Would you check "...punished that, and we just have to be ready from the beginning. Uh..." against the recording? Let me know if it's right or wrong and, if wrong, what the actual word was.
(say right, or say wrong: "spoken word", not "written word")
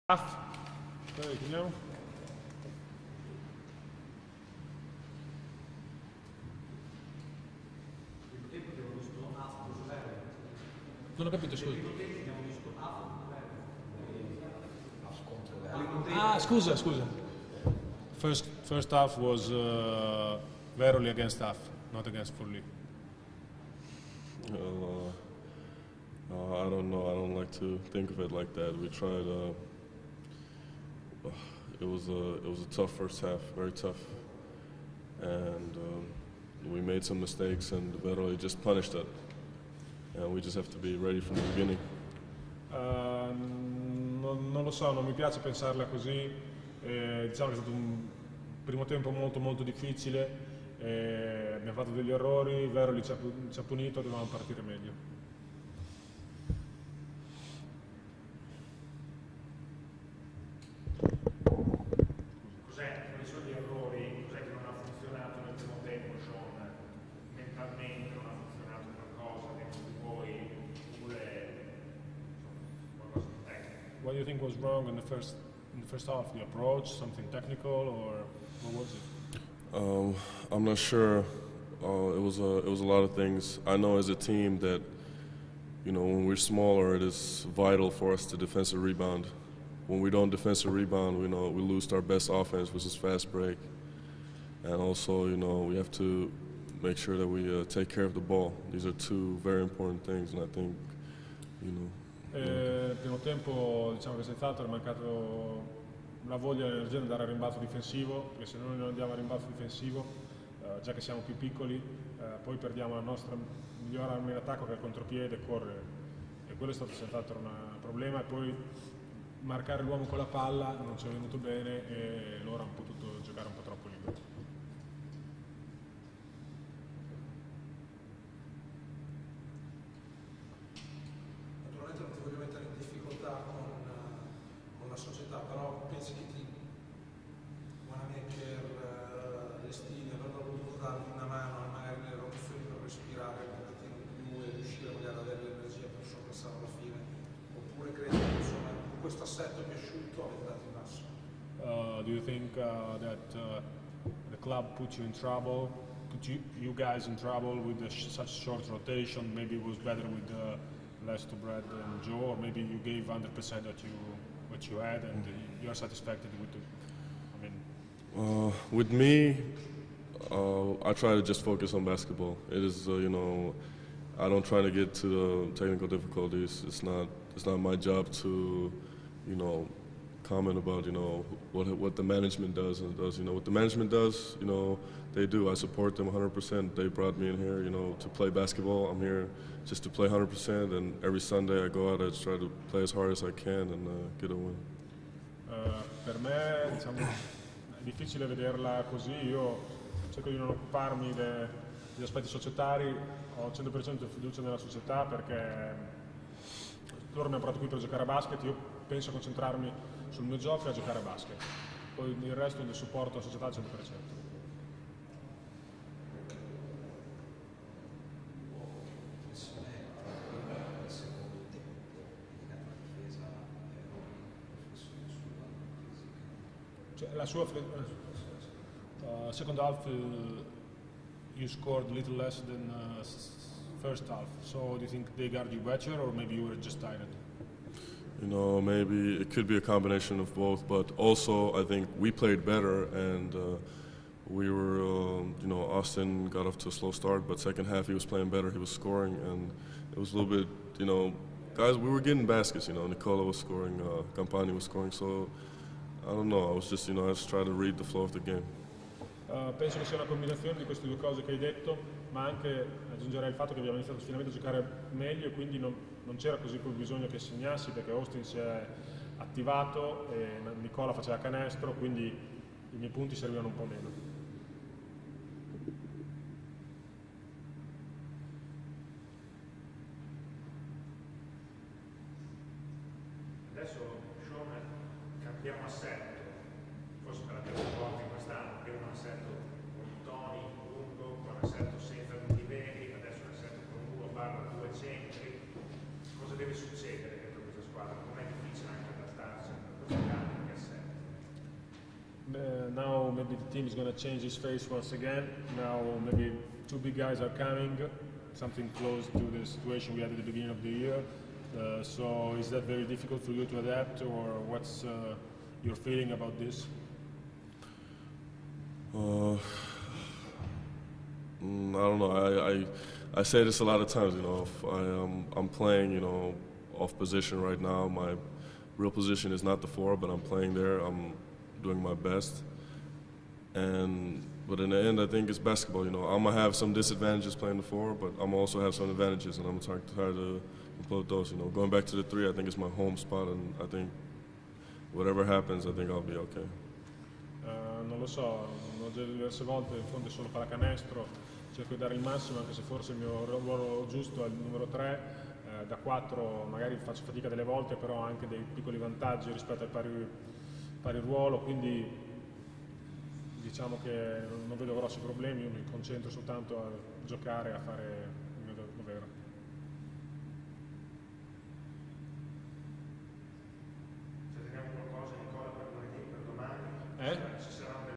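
right.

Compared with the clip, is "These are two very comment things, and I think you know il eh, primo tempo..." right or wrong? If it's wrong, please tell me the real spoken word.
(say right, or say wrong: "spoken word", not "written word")
wrong: "important", not "comment".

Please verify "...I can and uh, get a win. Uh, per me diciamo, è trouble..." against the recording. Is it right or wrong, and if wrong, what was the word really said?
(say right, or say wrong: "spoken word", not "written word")
wrong: "difficile", not "trouble".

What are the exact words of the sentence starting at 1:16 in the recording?
The approach, something technical, or what was it?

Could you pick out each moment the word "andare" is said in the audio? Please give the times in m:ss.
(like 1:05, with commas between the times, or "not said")
1:47.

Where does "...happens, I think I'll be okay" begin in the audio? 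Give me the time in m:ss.
5:45.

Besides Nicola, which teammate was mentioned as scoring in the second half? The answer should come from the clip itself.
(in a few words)
Campani.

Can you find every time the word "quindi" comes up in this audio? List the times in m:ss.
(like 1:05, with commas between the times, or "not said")
4:25, 4:31, 6:01.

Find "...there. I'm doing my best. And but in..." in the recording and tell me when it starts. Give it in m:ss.
5:30.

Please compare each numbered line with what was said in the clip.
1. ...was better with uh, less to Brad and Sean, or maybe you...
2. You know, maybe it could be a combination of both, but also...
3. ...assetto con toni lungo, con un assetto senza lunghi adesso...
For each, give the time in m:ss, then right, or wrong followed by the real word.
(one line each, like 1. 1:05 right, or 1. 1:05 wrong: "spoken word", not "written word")
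1. 2:39 wrong: "Joe", not "Sean"
2. 3:58 right
3. 4:48 right.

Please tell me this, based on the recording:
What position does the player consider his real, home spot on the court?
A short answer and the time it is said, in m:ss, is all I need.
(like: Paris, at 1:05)
3, at 5:42.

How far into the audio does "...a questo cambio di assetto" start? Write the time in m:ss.
4:59.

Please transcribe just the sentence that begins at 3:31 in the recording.
Poi il resto del supporto alla società al 100%.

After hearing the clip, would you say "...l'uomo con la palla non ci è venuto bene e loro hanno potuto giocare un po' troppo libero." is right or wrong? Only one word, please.
right.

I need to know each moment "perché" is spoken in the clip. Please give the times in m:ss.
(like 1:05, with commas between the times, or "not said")
1:48, 3:25, 4:27.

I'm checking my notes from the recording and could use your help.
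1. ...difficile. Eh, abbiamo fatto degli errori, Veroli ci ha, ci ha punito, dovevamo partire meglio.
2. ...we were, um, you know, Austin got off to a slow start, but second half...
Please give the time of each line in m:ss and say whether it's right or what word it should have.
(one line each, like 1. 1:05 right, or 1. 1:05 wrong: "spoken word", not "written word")
1. 0:49 right
2. 4:04 right.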